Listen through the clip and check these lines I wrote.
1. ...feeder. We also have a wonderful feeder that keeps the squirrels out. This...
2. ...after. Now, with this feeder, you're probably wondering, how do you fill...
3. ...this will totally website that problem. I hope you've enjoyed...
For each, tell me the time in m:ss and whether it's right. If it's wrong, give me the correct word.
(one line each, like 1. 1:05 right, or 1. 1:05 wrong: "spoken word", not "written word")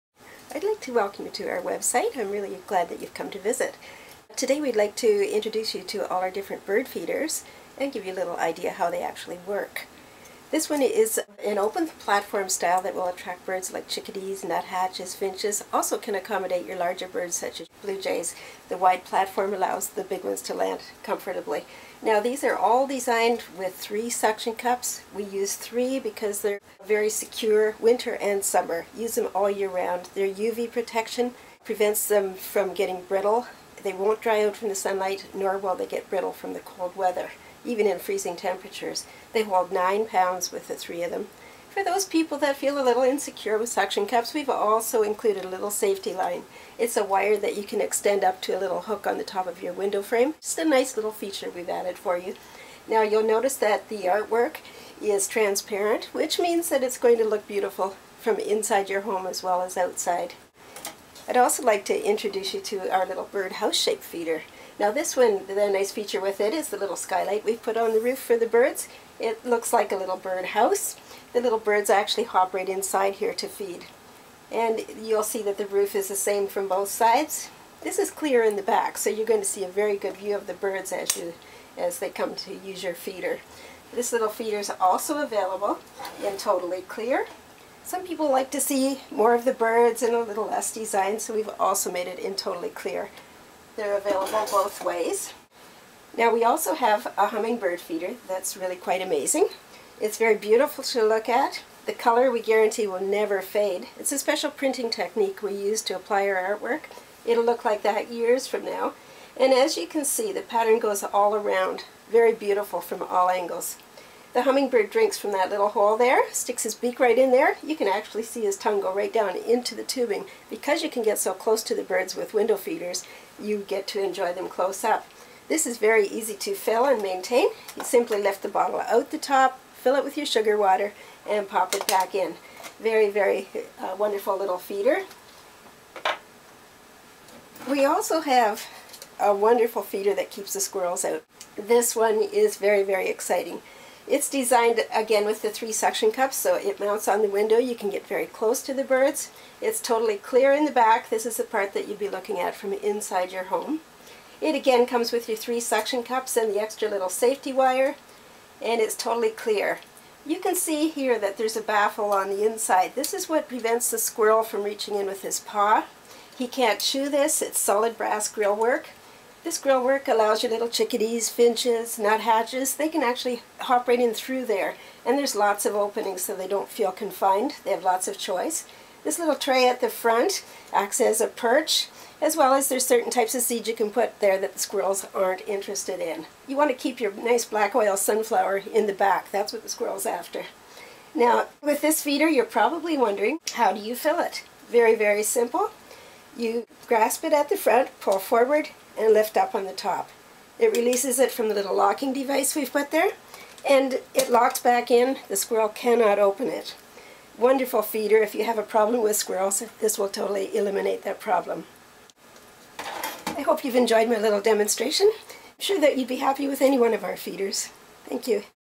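1. 2:14 right
2. 3:10 right
3. 3:29 wrong: "eliminate", not "website".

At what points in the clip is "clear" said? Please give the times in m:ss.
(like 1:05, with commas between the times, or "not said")
1:18, 1:26, 1:32, 2:30, 2:39.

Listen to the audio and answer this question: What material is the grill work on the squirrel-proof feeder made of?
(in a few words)
solid brass.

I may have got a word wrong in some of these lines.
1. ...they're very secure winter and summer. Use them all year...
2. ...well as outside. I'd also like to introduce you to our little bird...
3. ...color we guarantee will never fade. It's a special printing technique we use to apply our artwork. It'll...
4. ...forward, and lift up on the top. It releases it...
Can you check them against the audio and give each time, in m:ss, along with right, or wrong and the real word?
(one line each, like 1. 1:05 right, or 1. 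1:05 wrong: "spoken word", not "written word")
1. 0:26 right
2. 0:59 right
3. 1:41 right
4. 3:18 right.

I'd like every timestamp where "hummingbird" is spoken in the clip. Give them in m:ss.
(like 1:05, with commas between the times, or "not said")
1:37, 1:54.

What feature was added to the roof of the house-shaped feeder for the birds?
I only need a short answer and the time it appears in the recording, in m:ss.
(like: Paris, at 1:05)
skylight, at 1:06.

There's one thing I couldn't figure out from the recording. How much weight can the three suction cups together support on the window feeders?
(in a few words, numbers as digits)
9 pounds.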